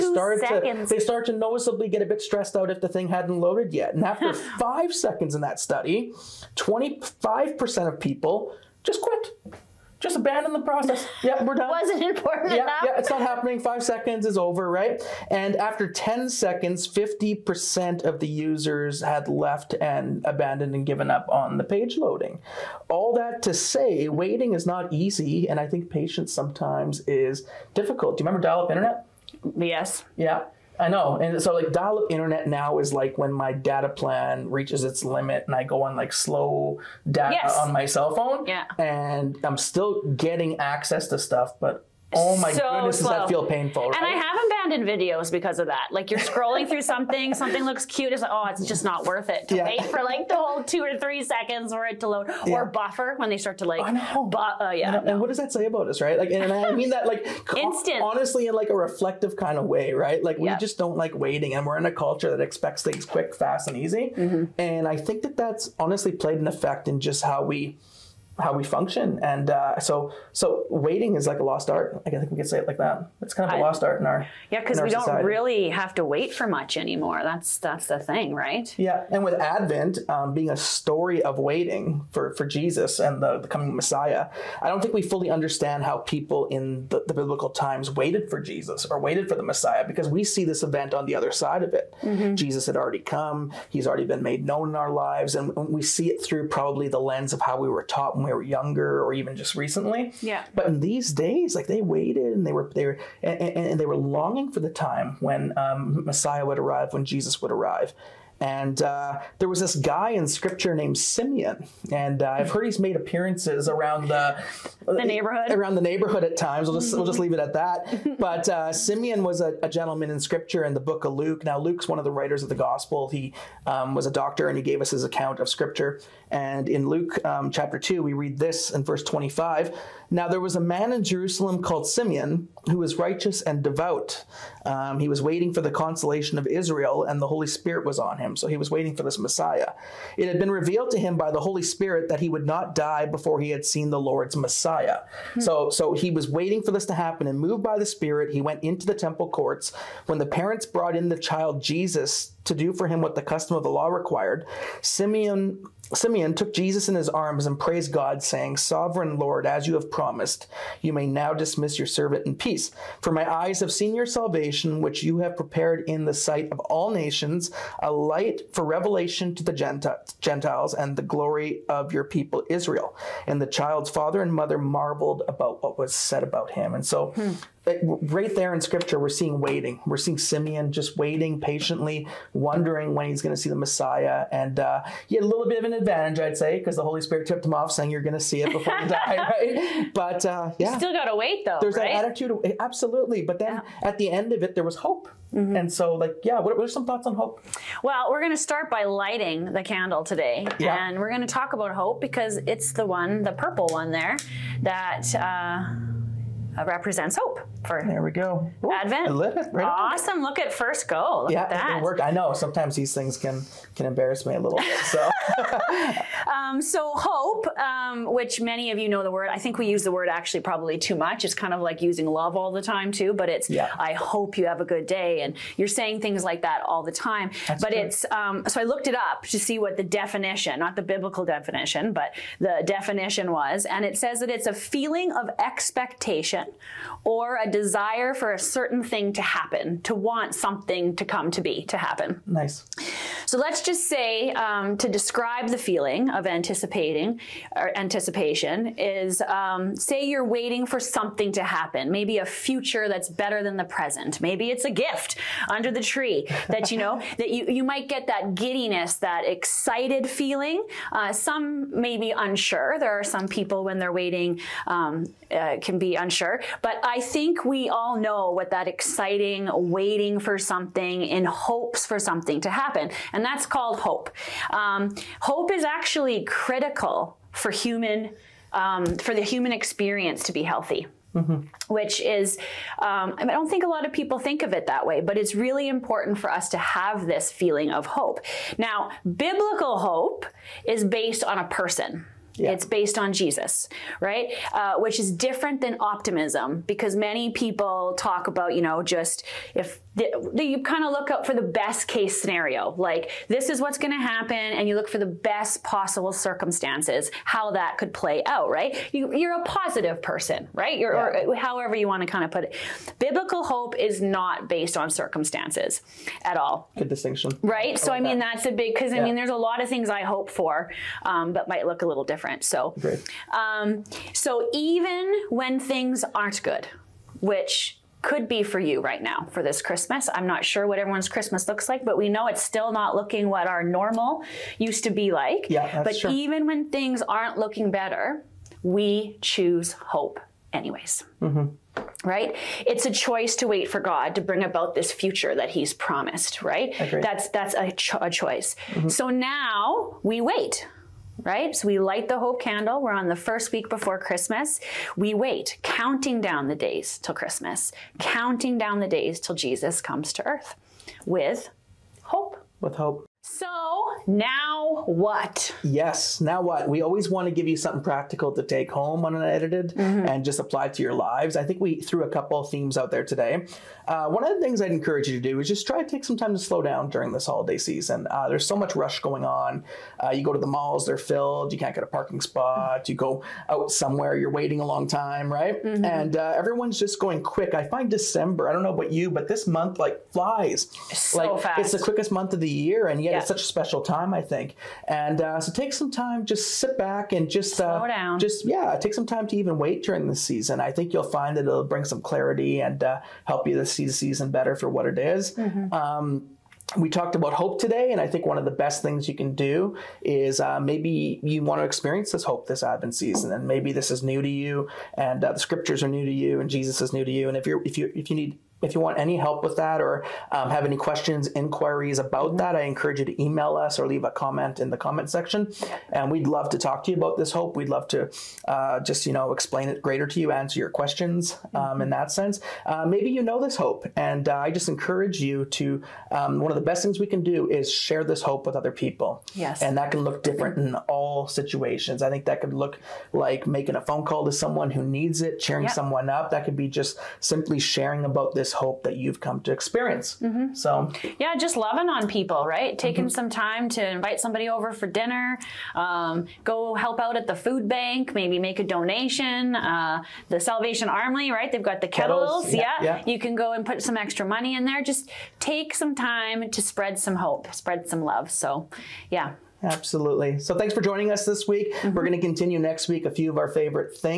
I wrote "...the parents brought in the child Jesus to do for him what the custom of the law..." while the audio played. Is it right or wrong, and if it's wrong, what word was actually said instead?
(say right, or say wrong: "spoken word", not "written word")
right.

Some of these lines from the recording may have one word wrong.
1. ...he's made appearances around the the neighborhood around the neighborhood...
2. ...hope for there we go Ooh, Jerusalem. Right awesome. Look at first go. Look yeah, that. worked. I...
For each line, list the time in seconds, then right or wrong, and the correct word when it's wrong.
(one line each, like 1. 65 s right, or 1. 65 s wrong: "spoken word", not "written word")
1. 112 s right
2. 207 s wrong: "Advent", not "Jerusalem".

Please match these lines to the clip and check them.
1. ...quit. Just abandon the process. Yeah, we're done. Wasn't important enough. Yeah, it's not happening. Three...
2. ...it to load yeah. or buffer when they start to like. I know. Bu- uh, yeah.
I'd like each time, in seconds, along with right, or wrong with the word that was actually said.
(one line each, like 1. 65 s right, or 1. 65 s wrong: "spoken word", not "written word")
1. 9 s wrong: "Five", not "Three"
2. 51 s right.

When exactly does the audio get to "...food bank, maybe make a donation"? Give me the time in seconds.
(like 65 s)
457 s.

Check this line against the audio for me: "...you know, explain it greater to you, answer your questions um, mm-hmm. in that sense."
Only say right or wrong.
right.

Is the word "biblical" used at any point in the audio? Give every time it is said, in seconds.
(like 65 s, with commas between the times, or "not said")
87 s, 230 s, 289 s, 312 s.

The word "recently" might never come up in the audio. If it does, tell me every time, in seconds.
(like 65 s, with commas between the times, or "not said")
99 s.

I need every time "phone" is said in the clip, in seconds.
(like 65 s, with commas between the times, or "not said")
38 s, 443 s.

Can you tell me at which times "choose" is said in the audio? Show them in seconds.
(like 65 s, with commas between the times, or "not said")
339 s.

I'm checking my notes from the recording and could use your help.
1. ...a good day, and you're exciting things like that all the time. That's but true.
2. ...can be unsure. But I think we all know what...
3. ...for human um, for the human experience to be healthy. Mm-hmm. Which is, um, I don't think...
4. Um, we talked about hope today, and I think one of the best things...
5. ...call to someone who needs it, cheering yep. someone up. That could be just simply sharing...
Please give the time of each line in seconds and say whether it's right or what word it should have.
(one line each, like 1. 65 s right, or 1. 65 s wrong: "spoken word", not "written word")
1. 224 s wrong: "saying", not "exciting"
2. 265 s right
3. 277 s right
4. 405 s right
5. 444 s right.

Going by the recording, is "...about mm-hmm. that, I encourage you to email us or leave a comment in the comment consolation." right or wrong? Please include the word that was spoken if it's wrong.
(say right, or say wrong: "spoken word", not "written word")
wrong: "section", not "consolation".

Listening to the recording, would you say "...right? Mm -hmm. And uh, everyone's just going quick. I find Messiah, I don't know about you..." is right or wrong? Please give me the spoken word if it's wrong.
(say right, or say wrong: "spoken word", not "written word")
wrong: "December", not "Messiah".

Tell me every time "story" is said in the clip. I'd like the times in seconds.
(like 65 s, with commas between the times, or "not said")
80 s.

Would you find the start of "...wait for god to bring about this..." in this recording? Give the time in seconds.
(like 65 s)
343 s.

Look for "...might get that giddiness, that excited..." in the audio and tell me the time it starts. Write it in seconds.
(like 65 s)
257 s.